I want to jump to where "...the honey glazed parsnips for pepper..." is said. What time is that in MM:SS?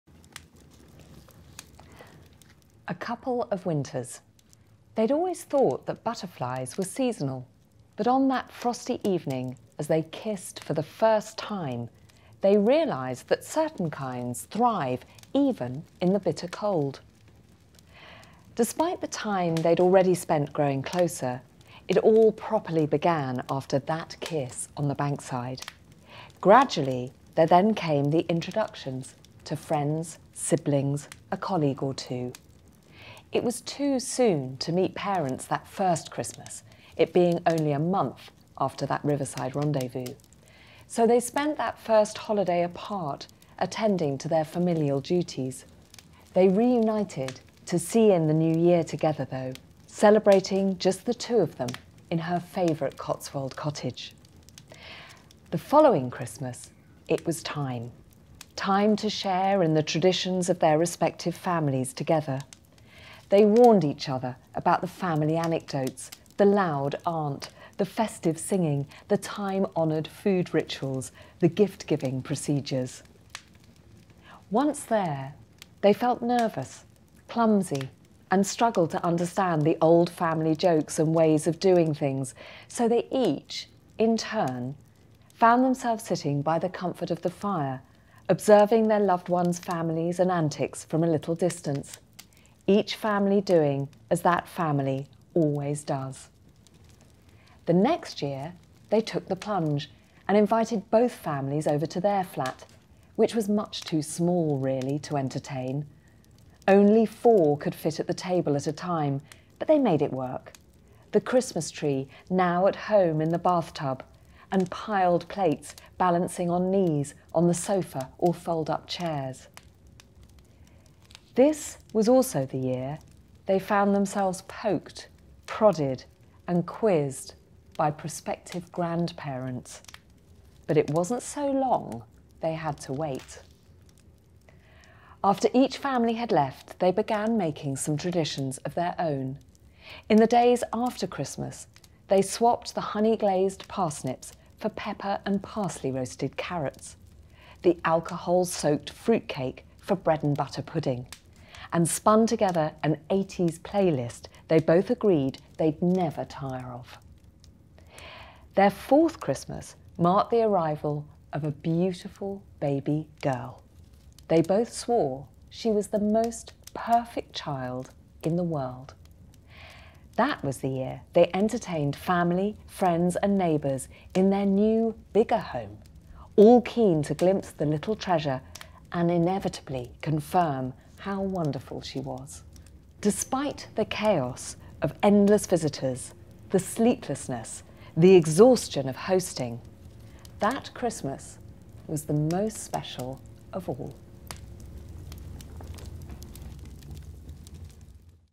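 02:22.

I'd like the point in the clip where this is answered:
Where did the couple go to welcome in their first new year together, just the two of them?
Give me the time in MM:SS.
00:52.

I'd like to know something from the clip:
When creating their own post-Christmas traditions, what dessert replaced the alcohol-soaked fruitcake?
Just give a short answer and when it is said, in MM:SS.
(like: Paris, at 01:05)
Bread and butter pudding, at 02:29.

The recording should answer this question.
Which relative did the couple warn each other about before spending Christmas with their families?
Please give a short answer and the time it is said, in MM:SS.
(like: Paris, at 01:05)
The loud aunt, at 01:06.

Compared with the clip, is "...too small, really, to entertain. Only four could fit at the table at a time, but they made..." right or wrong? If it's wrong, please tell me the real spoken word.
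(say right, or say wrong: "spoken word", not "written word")
right.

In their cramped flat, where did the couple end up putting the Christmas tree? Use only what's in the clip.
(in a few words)
The bathtub.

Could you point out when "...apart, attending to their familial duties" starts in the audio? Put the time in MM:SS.
00:42.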